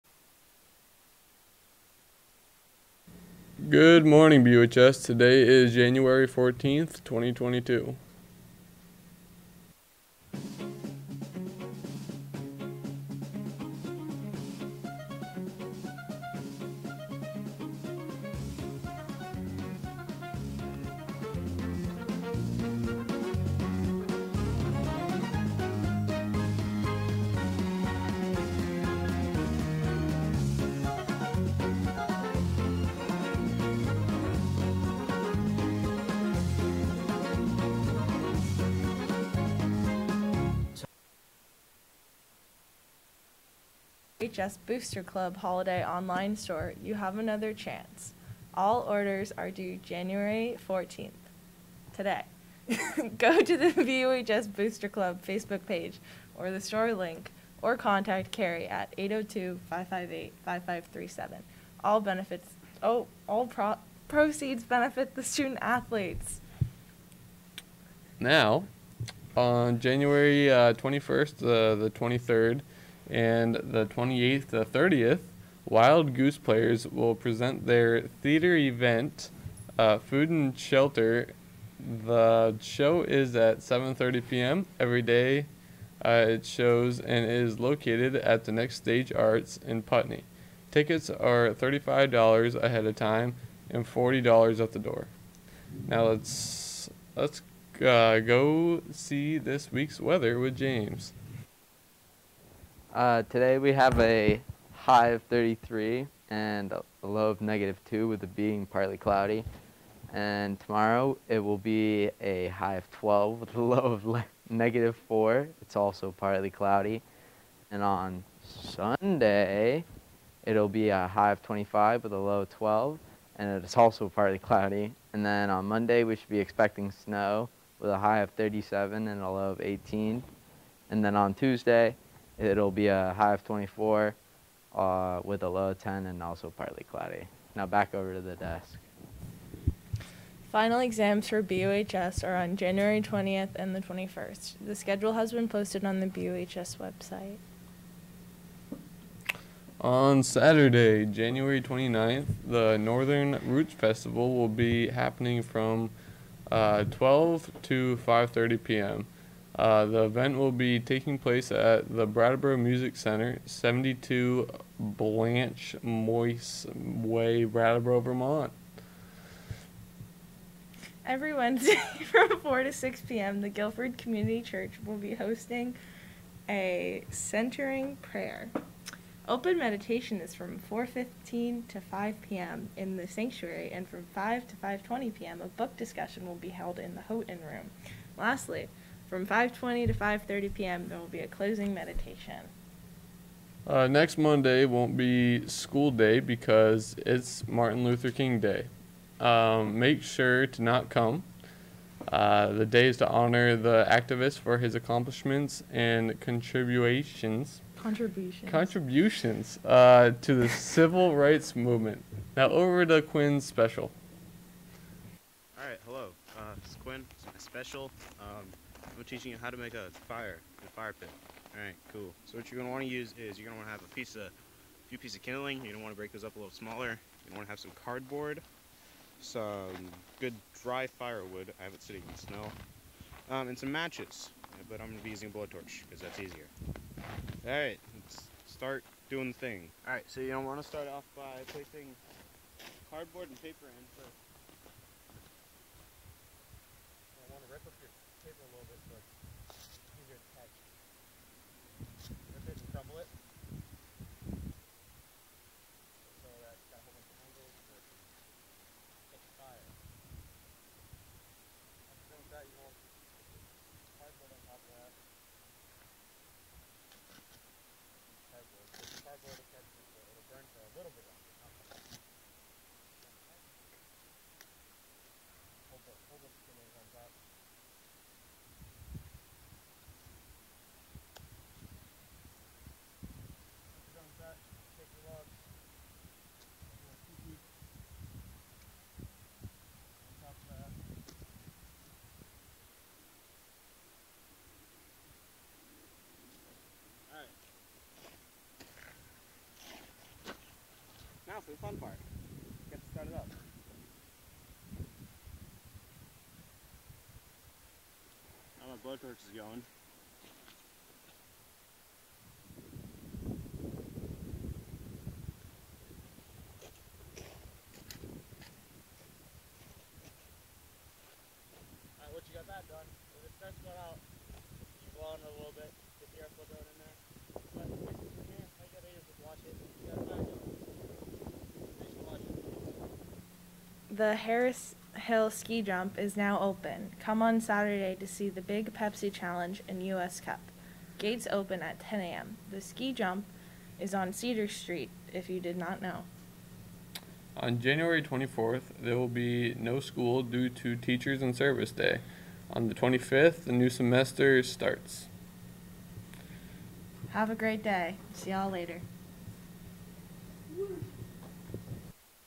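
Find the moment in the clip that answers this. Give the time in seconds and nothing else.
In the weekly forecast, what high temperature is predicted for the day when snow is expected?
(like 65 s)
128 s.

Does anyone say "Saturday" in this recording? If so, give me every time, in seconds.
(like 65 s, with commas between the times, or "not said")
150 s, 337 s.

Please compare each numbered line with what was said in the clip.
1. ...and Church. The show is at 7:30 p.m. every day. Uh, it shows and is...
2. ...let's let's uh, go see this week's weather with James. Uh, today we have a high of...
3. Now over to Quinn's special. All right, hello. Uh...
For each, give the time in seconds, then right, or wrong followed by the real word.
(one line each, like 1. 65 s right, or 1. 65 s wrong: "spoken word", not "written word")
1. 80 s wrong: "Shelter", not "Church"
2. 96 s right
3. 212 s right.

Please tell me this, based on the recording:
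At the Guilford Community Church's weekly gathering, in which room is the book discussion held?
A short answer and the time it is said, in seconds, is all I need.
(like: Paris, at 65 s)
Houghton room, at 187 s.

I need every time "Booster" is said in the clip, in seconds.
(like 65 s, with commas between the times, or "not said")
44 s, 54 s.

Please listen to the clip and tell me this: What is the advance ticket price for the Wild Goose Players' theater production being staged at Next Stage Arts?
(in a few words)
$35.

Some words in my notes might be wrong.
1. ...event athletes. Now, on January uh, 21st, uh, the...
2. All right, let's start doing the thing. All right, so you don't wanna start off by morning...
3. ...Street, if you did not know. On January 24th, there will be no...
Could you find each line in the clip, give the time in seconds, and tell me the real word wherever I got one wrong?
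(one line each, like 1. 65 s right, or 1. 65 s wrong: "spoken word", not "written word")
1. 65 s wrong: "student", not "event"
2. 236 s wrong: "placing", not "morning"
3. 344 s right.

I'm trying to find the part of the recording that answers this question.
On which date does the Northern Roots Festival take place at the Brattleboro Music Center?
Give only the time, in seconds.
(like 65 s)
151 s.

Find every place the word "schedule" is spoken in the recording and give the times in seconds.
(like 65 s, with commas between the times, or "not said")
144 s.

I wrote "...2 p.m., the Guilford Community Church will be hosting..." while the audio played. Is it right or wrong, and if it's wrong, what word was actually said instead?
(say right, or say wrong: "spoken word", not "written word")
wrong: "6", not "2".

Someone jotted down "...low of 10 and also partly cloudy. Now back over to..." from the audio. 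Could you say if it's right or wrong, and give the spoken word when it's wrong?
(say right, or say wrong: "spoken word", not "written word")
right.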